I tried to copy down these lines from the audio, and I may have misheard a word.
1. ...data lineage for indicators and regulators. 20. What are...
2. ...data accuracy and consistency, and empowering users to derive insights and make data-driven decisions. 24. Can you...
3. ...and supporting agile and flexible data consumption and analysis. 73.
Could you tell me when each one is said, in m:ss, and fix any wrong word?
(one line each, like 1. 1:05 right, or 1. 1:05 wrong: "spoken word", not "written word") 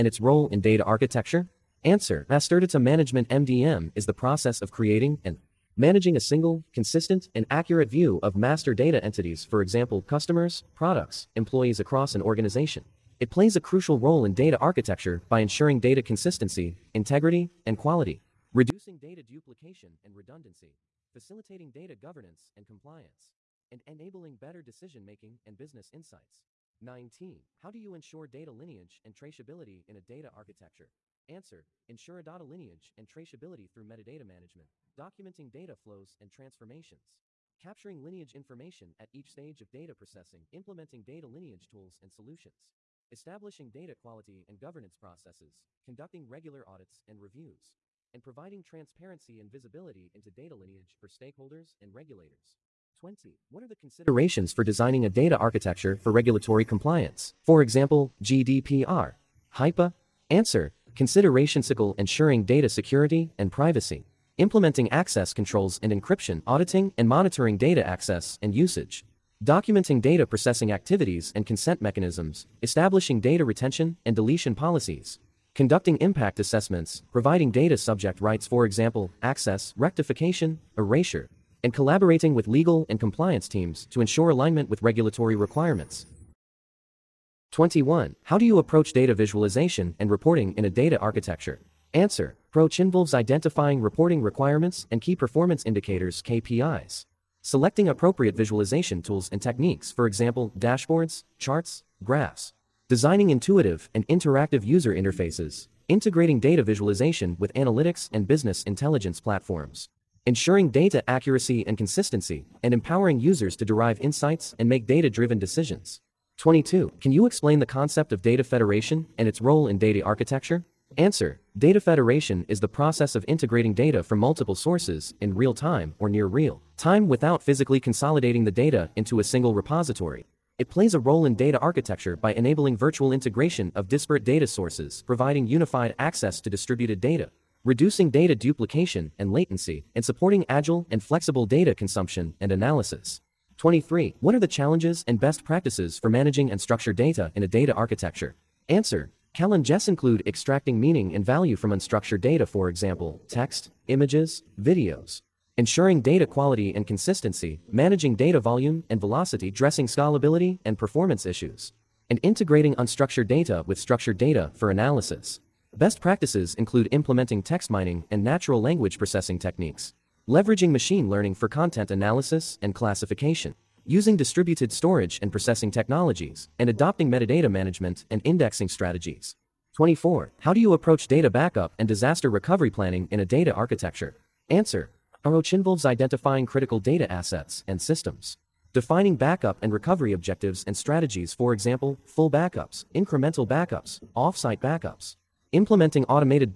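1. 0:50 wrong: "stakeholders", not "indicators"
2. 1:50 wrong: "22", not "24"
3. 2:19 wrong: "23", not "73".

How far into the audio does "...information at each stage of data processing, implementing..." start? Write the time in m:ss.
0:38.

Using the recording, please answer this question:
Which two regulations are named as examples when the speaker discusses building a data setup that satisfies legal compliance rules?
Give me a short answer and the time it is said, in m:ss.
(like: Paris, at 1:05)
GDPR, HIPAA, at 0:58.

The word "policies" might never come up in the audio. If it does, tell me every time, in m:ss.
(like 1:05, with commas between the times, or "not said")
1:14.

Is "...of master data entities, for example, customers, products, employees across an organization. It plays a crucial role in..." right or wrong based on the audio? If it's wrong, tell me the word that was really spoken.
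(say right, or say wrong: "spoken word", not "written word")
right.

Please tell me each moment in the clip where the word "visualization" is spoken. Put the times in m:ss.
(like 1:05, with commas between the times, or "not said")
1:29, 1:38, 1:46.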